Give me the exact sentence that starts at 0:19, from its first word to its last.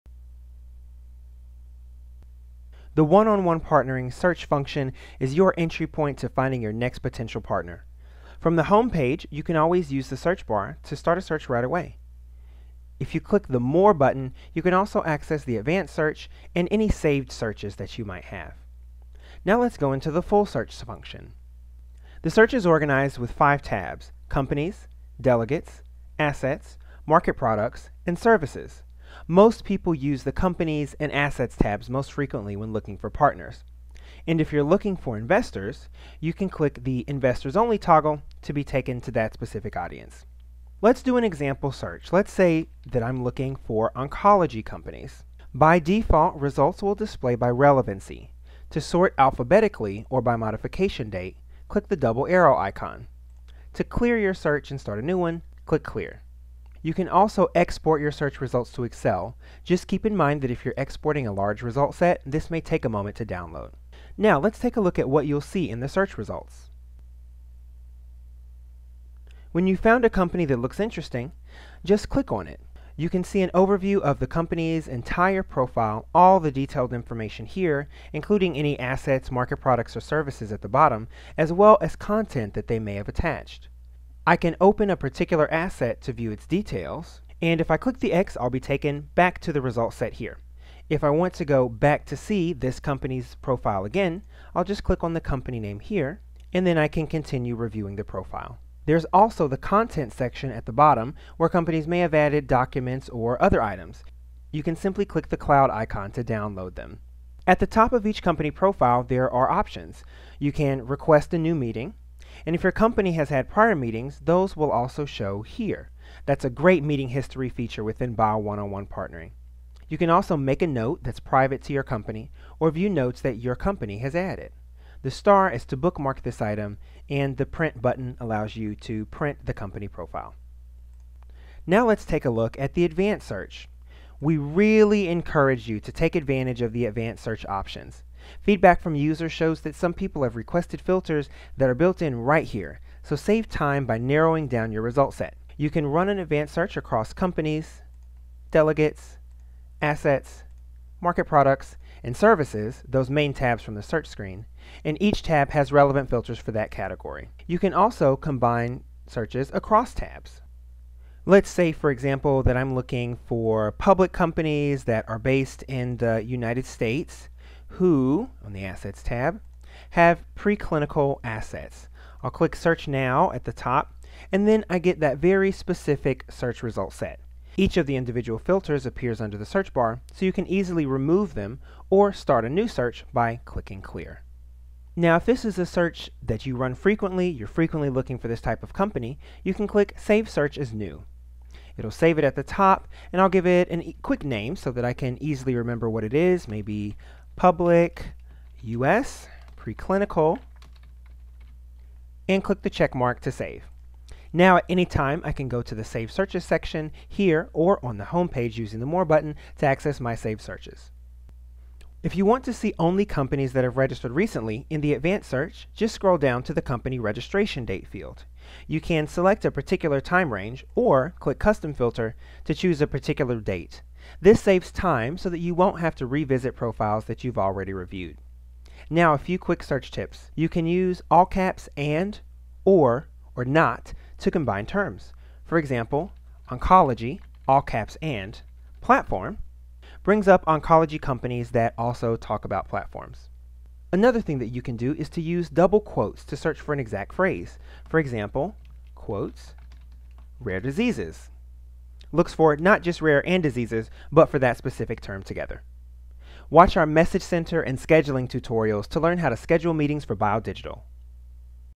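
Now let's go into the full search function.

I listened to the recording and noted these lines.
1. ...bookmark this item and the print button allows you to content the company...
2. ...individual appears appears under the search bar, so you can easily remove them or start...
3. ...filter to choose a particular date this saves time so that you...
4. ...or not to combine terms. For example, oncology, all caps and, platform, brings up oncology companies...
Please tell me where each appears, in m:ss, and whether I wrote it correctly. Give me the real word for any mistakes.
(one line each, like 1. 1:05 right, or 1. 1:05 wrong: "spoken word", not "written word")
1. 2:05 wrong: "print", not "content"
2. 2:57 wrong: "filters", not "appears"
3. 3:41 right
4. 3:53 right.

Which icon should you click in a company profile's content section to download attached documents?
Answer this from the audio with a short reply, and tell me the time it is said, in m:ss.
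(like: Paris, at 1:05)
cloud icon, at 1:45.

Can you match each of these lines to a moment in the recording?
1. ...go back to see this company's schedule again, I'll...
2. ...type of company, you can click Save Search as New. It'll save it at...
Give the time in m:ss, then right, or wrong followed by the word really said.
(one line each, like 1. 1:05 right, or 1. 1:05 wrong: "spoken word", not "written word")
1. 1:31 wrong: "profile", not "schedule"
2. 3:08 right.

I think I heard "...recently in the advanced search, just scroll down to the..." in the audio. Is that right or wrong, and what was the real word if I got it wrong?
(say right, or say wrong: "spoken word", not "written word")
right.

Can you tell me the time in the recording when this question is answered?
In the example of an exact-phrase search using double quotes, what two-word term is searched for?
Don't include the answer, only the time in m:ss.
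4:10.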